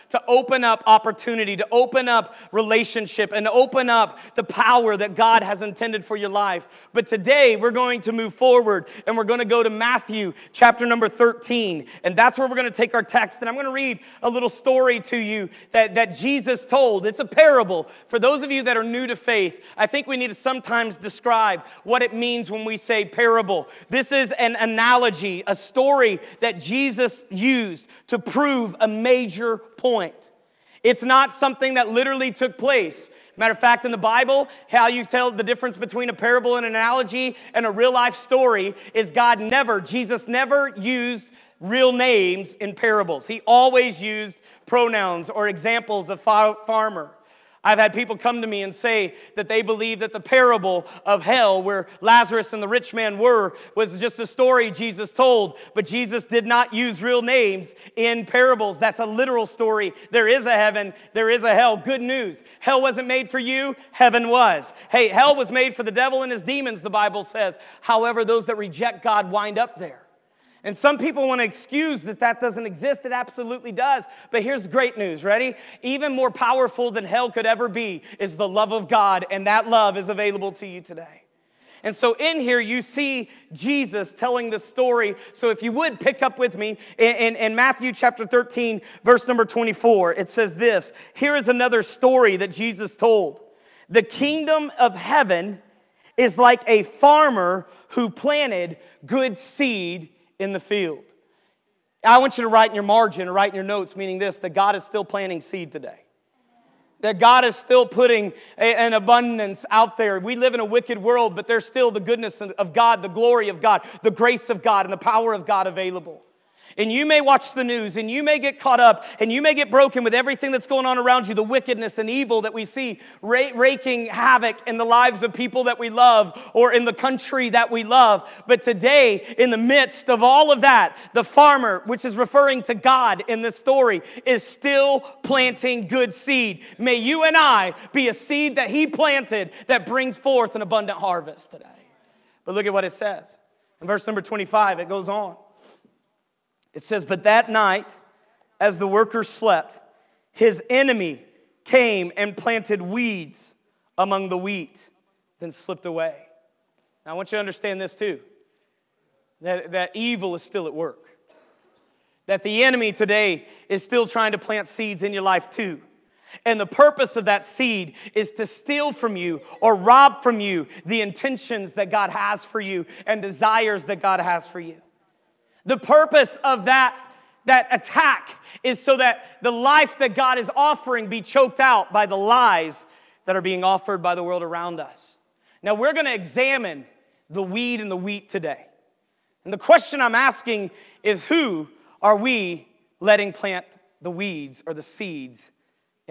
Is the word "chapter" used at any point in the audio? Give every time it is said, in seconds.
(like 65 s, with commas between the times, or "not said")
10 s, 87 s.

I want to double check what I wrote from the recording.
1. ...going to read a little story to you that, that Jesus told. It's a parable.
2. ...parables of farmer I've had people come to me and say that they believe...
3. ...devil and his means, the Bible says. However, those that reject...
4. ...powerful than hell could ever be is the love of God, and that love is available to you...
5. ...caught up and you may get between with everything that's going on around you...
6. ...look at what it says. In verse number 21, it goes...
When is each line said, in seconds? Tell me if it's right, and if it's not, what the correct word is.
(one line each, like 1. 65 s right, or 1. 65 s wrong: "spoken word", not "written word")
1. 13 s right
2. 45 s wrong: "examples", not "parables"
3. 65 s wrong: "demons", not "means"
4. 76 s right
5. 118 s wrong: "broken", not "between"
6. 142 s wrong: "25", not "21".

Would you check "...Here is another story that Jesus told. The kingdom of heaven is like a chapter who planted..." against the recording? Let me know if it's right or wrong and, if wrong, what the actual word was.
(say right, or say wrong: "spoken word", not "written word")
wrong: "farmer", not "chapter".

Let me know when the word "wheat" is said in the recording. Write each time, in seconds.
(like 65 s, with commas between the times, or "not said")
154 s, 187 s.